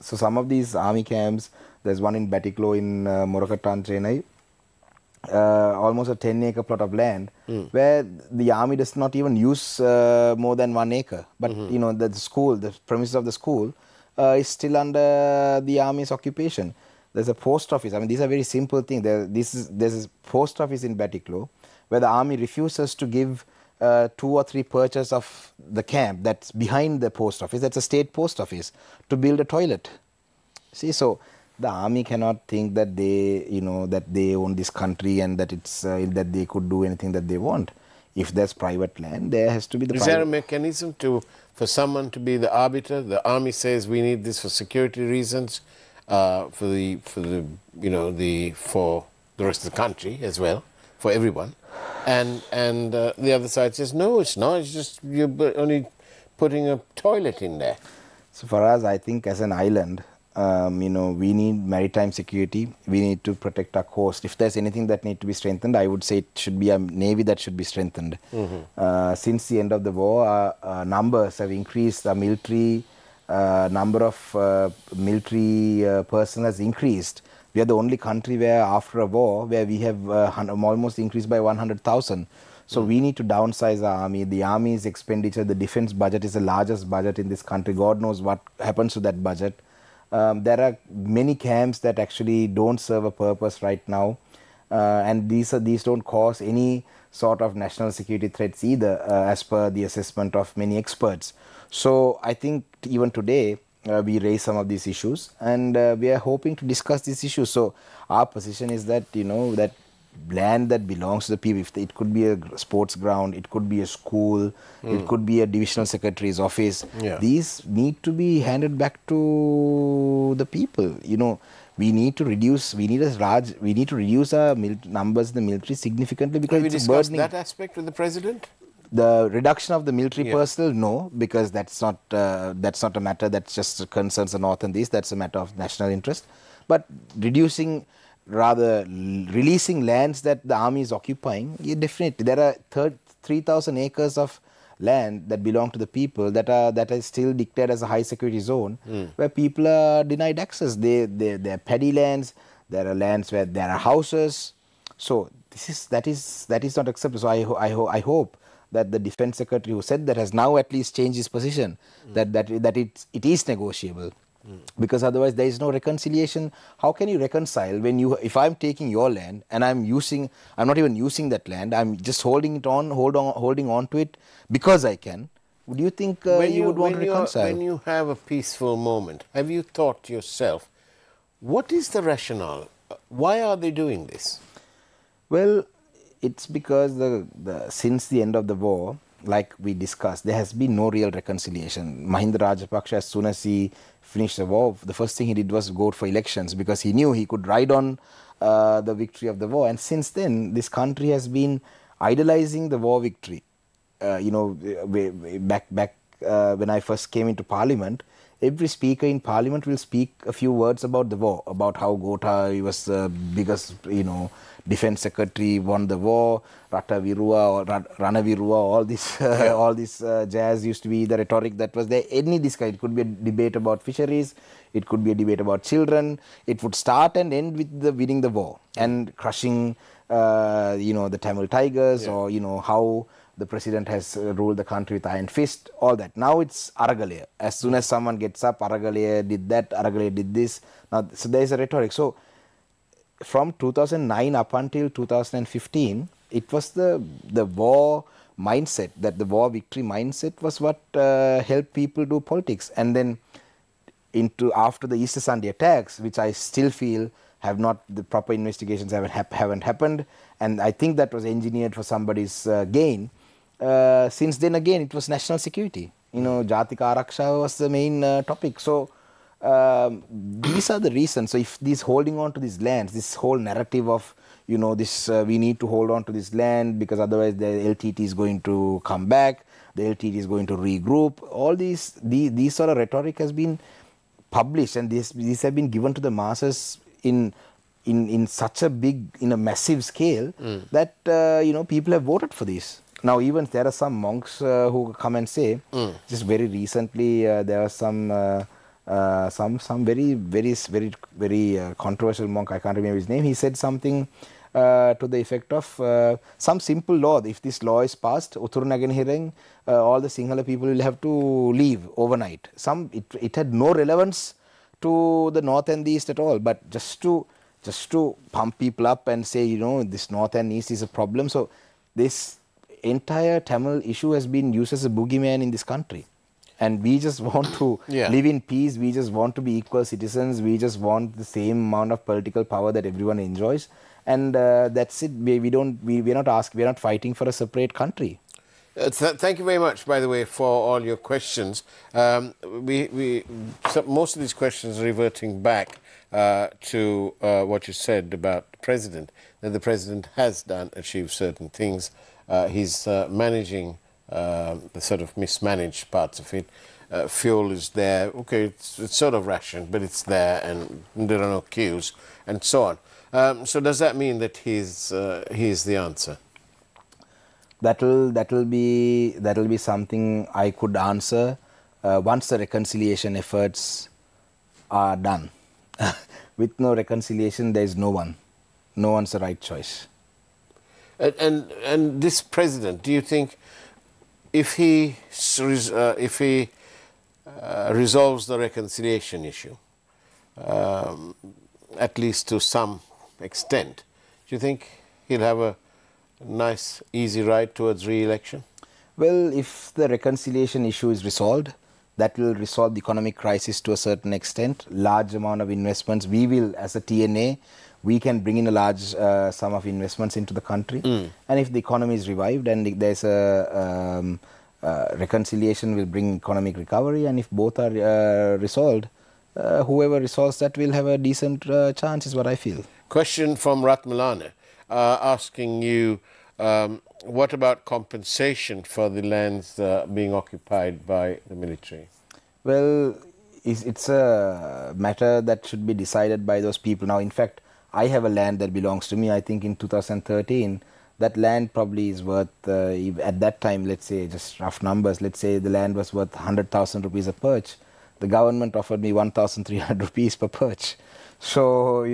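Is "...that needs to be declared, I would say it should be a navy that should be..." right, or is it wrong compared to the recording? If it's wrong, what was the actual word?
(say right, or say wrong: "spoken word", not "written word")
wrong: "strengthened", not "declared".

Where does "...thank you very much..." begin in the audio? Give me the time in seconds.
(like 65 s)
339 s.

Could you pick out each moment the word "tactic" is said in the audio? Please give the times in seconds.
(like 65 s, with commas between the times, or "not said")
not said.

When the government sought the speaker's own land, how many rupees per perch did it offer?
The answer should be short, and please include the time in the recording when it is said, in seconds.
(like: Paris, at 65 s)
1,300 rupees, at 448 s.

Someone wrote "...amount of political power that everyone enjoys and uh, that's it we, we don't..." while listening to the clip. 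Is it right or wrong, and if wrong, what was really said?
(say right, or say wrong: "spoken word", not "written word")
right.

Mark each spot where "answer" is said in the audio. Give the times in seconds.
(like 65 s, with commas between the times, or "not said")
365 s, 370 s.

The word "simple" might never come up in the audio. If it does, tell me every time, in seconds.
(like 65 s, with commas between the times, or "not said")
18 s, 306 s.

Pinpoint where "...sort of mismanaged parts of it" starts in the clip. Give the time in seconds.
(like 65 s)
354 s.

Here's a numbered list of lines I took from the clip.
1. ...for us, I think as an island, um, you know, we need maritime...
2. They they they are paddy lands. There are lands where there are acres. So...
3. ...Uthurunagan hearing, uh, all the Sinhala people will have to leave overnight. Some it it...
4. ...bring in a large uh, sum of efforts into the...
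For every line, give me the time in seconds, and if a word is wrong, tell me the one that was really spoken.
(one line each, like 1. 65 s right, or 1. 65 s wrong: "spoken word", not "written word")
1. 58 s right
2. 150 s wrong: "houses", not "acres"
3. 308 s right
4. 408 s wrong: "investments", not "efforts".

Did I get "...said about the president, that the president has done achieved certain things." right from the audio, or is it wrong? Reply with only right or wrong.
right.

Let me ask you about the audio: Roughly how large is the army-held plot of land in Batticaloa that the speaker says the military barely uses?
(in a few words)
10 acres.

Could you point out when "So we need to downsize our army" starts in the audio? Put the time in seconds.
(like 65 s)
82 s.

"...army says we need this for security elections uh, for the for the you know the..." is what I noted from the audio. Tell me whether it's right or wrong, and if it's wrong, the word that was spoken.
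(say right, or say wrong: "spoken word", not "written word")
wrong: "reasons", not "elections".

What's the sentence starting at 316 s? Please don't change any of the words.
But just to just to pump people up and say you know this north and east is a problem.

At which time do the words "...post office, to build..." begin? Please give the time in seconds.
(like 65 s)
28 s.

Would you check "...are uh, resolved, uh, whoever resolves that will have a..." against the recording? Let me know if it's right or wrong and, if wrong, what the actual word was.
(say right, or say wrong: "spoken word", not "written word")
right.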